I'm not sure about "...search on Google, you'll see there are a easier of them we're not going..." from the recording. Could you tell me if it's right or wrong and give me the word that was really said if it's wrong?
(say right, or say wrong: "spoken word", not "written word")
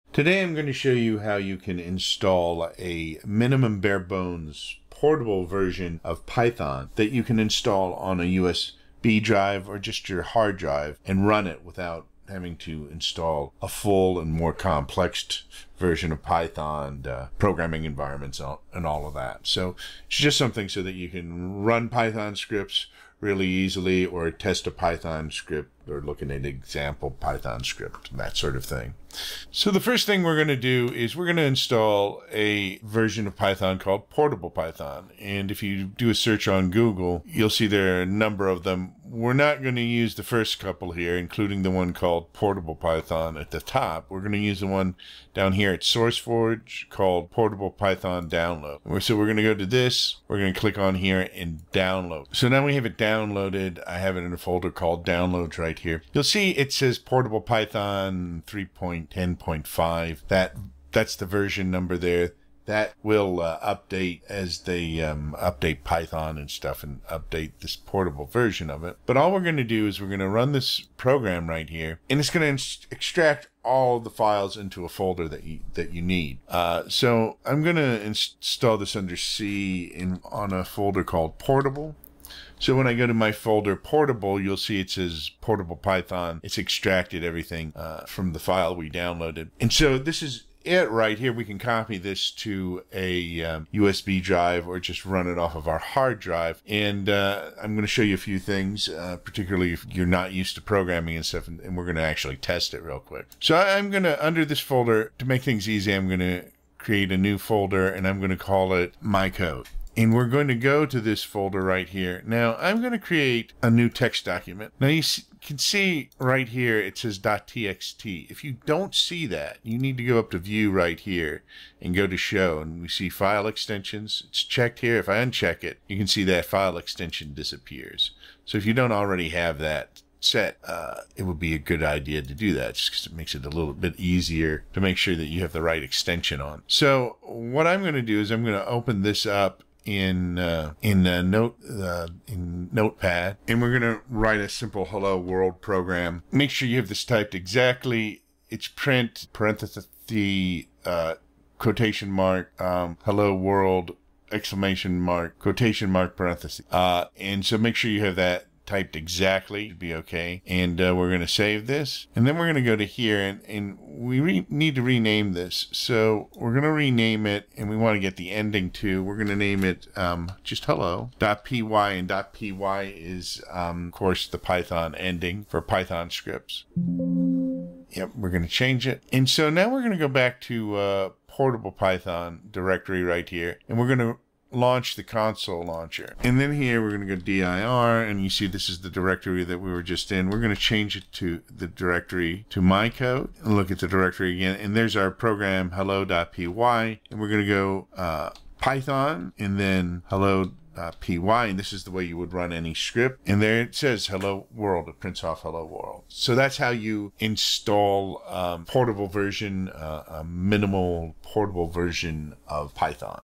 wrong: "number", not "easier".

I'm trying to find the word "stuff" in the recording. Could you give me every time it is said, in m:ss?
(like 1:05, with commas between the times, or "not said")
1:06, 1:41.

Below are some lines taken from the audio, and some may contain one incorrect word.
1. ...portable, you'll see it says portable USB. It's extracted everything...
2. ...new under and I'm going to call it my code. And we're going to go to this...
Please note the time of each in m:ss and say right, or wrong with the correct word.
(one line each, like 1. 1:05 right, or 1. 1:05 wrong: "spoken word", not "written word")
1. 1:23 wrong: "Python", not "USB"
2. 1:47 wrong: "folder", not "under".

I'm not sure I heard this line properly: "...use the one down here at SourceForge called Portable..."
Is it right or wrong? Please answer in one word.
right.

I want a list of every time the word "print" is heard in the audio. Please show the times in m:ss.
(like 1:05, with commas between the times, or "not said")
2:28, 3:25.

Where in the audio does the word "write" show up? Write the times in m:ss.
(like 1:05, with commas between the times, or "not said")
2:24.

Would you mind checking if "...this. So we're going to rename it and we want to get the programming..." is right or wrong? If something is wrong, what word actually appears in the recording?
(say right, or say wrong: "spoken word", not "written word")
wrong: "ending", not "programming".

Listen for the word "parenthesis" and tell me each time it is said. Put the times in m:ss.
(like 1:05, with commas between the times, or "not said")
2:29, 2:36.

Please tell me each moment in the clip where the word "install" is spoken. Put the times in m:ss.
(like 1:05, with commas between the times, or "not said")
0:01, 0:07, 0:12, 0:31, 1:18, 3:27.